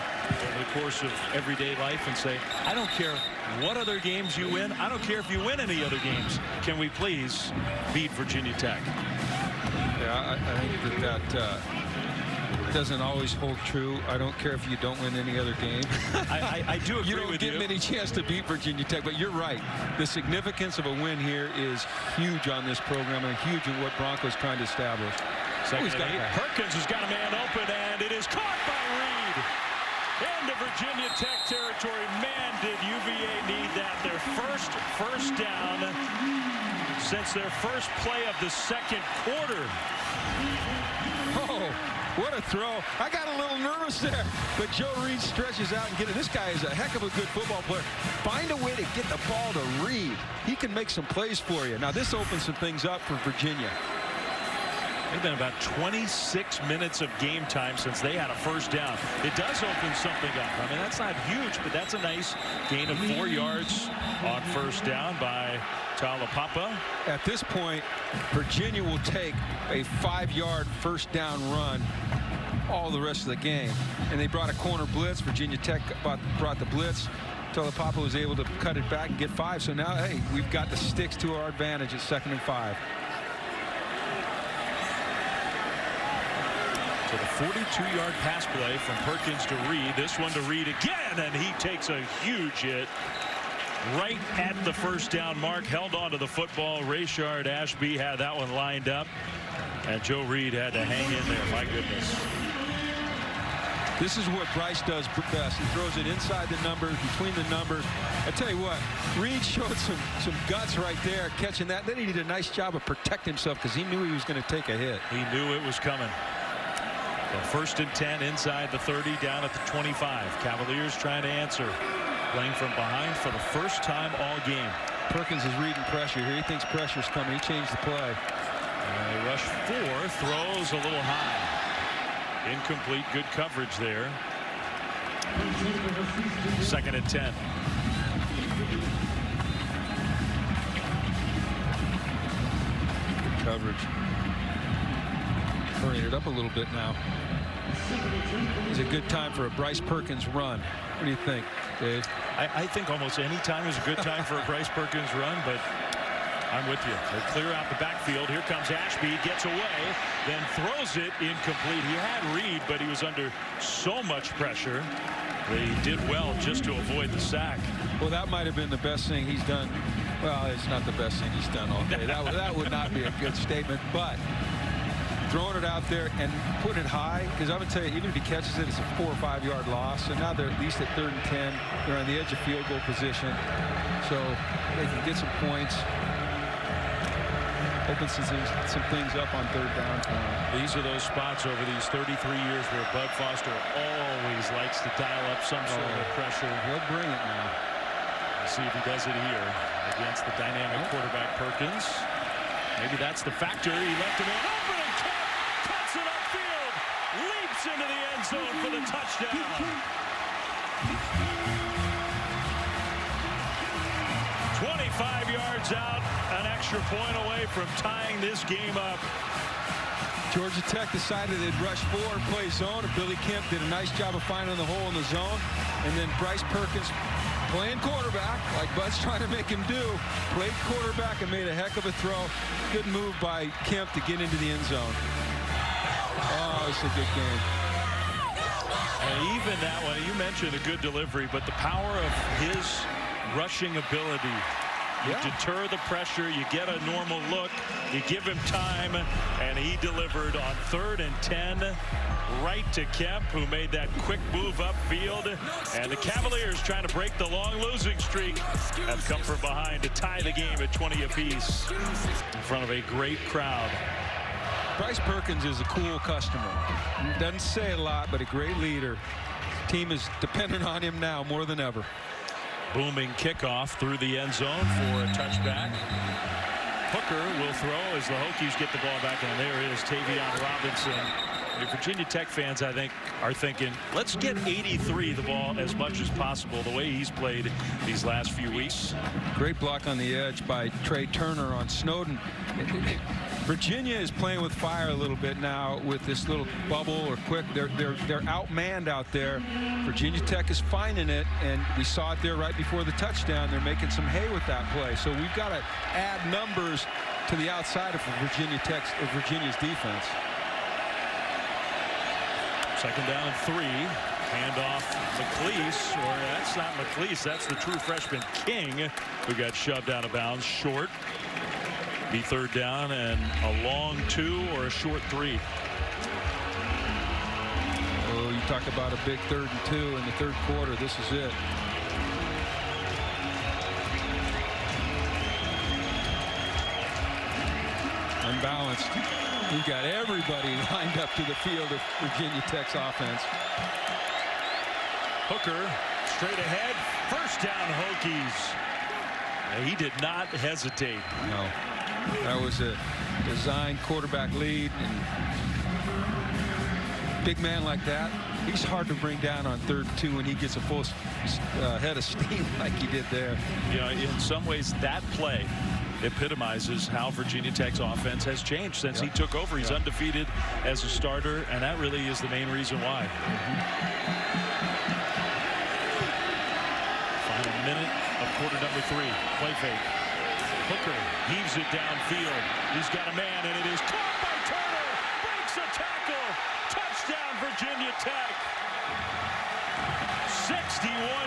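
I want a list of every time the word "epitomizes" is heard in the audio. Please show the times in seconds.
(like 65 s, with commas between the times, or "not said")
366 s.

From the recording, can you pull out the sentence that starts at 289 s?
Great block on the edge by Tre Turner on Snowden.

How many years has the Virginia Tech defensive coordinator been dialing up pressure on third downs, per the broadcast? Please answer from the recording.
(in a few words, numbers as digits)
33.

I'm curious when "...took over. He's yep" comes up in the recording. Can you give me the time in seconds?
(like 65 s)
369 s.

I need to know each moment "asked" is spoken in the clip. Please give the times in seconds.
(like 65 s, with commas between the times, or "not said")
not said.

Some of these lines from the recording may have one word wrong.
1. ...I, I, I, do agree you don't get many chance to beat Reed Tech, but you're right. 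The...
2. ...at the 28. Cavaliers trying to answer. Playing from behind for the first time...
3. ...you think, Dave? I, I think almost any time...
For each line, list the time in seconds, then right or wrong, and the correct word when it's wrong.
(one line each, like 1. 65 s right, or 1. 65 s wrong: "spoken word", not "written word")
1. 16 s wrong: "Virginia", not "Reed"
2. 119 s wrong: "25", not "28"
3. 151 s right.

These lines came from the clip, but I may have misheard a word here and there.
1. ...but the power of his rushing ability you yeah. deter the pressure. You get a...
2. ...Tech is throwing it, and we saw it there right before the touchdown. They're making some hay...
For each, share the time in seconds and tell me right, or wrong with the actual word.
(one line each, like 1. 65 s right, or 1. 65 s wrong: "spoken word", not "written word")
1. 241 s right
2. 300 s wrong: "finding", not "throwing".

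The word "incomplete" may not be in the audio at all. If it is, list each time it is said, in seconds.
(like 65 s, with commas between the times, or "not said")
132 s, 161 s.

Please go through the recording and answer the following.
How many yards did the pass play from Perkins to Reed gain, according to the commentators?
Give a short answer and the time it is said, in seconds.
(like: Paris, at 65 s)
42, at 87 s.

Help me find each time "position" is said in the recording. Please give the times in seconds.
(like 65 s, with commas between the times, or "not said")
182 s.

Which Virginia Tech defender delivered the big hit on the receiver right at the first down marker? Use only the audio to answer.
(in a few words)
Rayshard Ashby.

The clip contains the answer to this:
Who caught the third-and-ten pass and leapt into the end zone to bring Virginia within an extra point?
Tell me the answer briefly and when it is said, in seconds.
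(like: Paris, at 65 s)
Billy Kemp, at 222 s.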